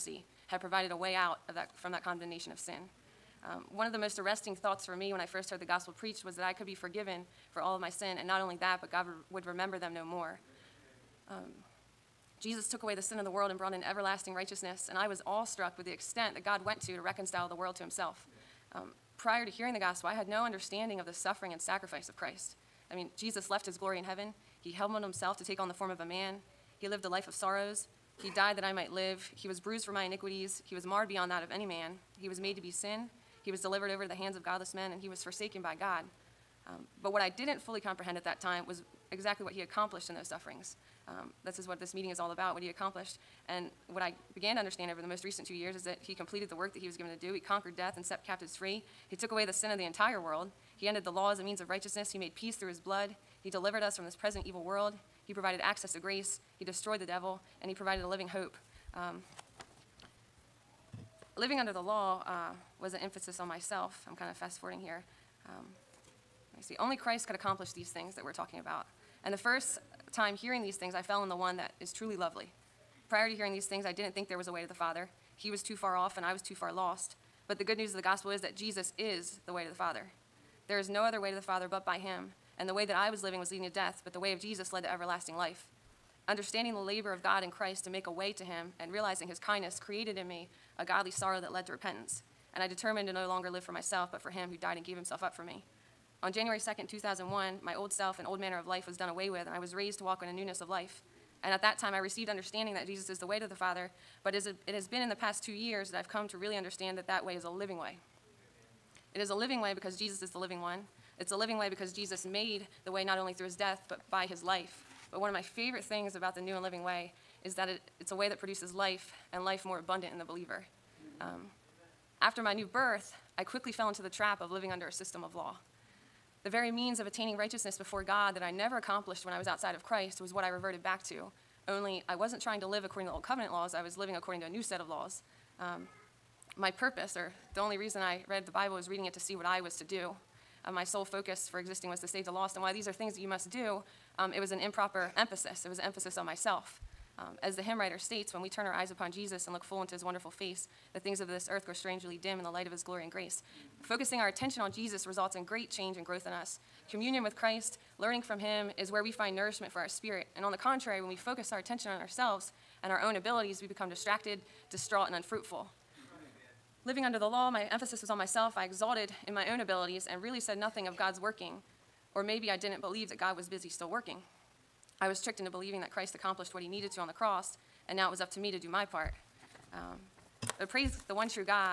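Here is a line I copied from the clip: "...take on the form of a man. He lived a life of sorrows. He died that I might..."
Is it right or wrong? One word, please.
right.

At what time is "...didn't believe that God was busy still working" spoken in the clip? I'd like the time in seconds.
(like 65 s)
172 s.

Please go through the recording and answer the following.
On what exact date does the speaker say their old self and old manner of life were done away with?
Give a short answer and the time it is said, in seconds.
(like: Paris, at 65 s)
January 2, 2001, at 96 s.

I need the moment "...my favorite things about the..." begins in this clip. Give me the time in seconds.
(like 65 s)
115 s.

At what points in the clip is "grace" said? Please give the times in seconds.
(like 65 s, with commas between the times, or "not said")
55 s, 153 s.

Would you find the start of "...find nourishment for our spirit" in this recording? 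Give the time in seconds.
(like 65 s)
159 s.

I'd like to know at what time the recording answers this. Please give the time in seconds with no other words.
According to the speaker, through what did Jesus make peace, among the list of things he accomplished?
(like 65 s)
52 s.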